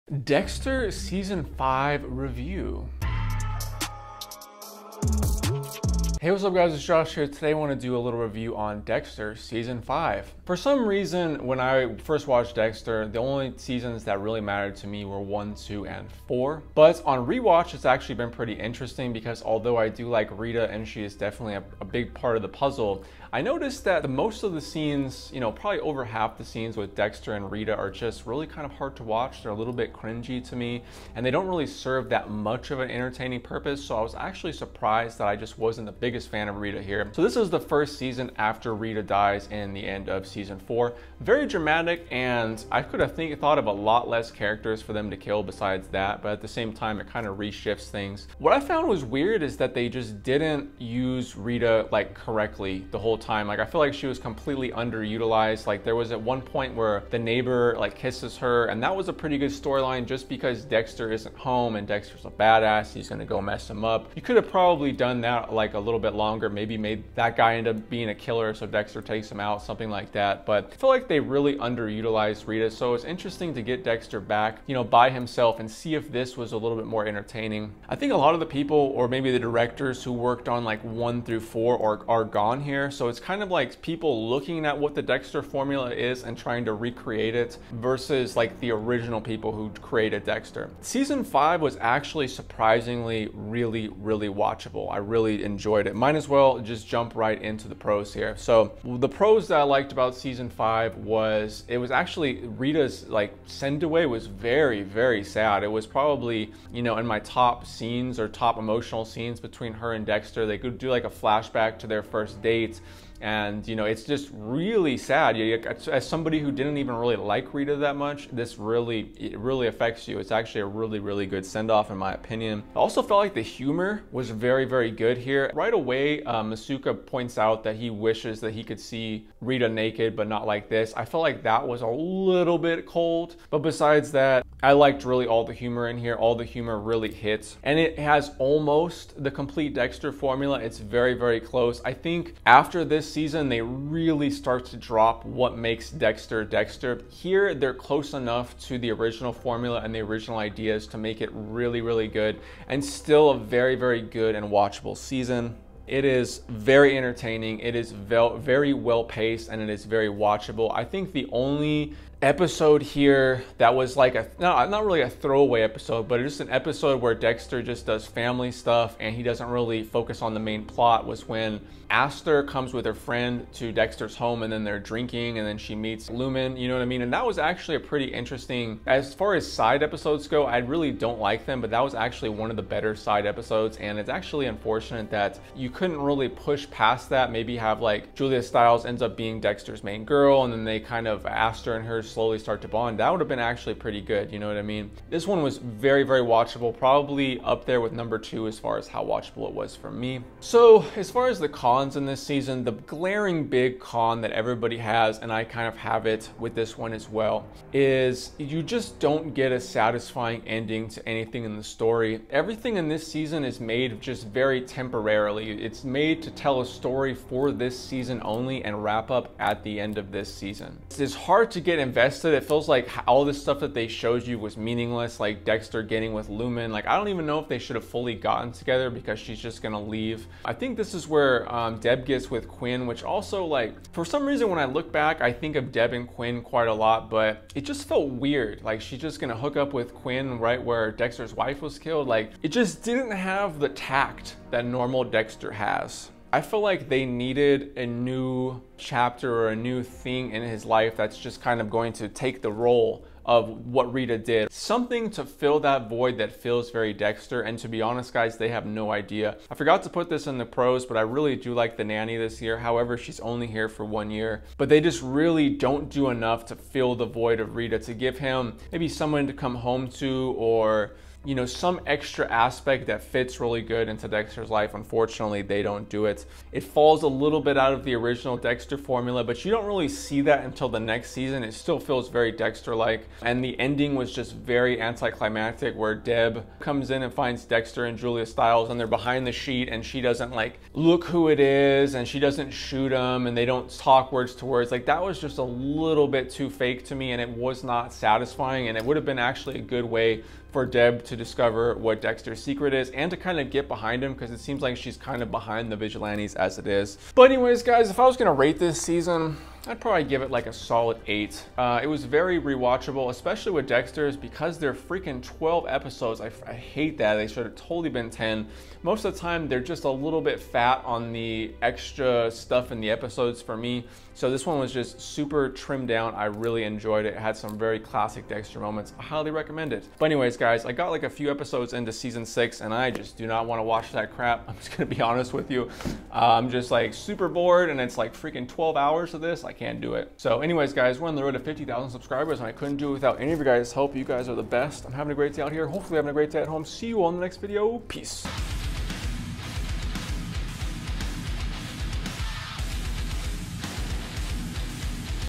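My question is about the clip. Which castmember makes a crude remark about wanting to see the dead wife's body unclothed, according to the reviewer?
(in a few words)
Masuka.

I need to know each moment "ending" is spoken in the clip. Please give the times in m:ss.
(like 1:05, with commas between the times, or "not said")
3:30, 4:43.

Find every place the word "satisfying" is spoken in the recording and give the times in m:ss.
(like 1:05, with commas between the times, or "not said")
3:29, 4:57.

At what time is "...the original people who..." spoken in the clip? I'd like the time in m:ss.
1:28.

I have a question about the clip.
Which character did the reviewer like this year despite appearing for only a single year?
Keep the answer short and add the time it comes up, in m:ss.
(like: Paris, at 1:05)
the nanny, at 4:21.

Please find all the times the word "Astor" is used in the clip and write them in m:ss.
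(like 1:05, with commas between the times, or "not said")
2:51, 3:11.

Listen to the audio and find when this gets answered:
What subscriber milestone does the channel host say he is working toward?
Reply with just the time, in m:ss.
5:41.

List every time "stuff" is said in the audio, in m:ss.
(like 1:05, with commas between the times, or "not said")
2:48, 3:43, 5:22.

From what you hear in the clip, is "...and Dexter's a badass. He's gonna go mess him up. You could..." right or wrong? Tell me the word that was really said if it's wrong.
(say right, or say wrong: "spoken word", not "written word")
right.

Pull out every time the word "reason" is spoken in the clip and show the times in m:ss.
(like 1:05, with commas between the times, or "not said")
0:10, 3:54.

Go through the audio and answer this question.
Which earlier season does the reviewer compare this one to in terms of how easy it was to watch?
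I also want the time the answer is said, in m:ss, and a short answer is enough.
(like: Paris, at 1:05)
Season 2, at 3:17.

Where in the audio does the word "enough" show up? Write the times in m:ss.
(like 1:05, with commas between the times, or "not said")
2:28, 4:26.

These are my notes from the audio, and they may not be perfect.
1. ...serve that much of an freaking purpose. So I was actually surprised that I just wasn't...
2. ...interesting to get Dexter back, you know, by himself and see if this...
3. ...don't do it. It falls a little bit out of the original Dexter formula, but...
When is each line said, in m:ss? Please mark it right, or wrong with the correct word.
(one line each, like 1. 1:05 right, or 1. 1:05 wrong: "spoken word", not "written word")
1. 0:31 wrong: "entertaining", not "freaking"
2. 1:13 right
3. 4:35 right.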